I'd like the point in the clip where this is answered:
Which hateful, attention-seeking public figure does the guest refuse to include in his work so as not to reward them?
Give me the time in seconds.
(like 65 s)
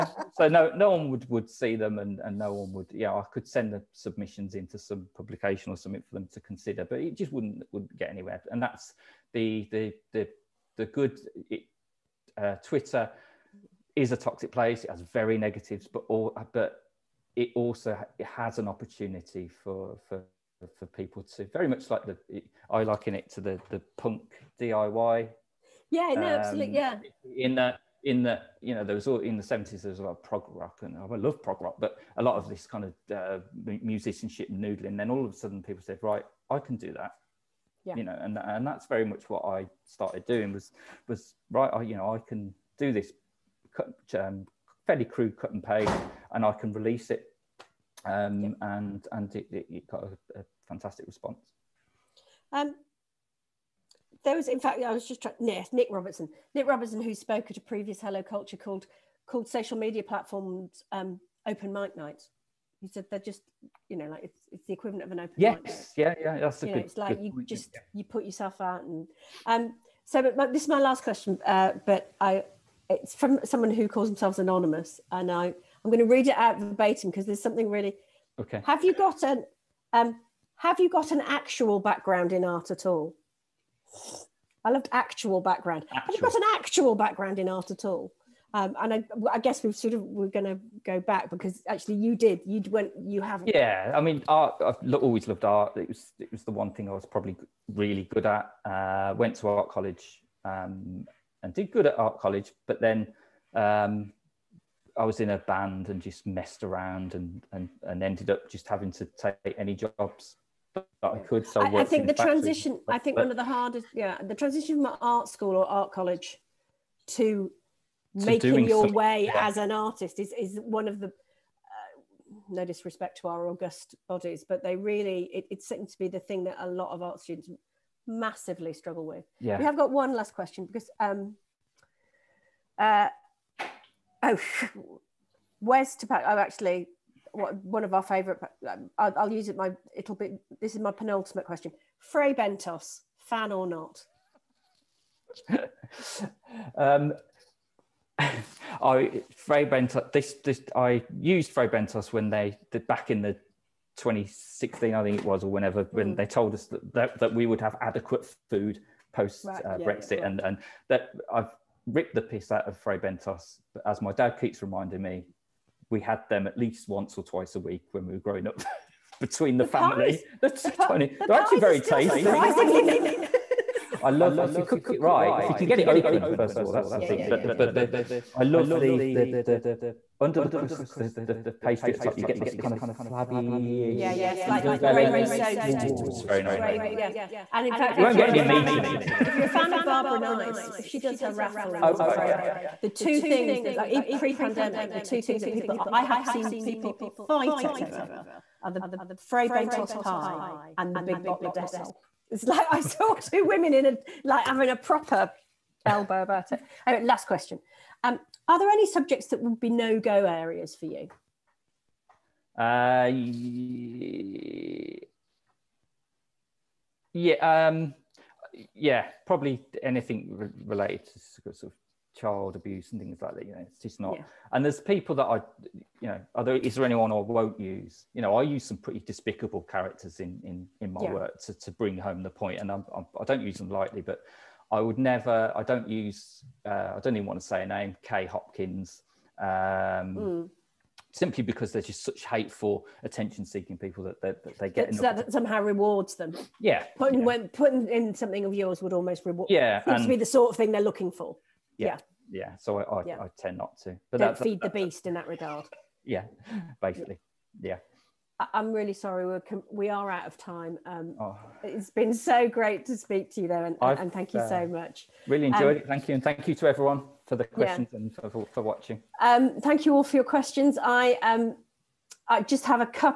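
238 s.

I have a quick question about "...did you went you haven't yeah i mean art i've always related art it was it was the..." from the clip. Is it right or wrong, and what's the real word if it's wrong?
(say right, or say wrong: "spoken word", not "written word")
wrong: "loved", not "related".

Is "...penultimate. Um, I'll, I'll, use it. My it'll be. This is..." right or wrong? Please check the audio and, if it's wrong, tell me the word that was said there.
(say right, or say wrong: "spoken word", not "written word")
wrong: "favourite", not "penultimate".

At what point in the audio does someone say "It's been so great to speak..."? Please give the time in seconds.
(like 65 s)
261 s.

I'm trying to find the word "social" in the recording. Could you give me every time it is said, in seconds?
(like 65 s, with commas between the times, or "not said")
59 s.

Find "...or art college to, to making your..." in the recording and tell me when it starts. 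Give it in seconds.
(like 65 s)
115 s.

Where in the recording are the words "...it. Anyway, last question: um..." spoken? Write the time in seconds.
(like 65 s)
206 s.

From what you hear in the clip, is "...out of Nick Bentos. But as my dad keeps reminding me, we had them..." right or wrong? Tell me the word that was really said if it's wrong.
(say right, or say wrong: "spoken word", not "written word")
wrong: "Fray", not "Nick".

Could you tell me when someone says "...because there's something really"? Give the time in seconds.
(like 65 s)
77 s.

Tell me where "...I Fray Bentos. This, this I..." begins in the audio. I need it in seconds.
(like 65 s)
148 s.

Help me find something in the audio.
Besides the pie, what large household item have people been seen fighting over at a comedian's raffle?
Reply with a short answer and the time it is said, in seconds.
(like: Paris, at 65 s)
big bottle of Dettol, at 200 s.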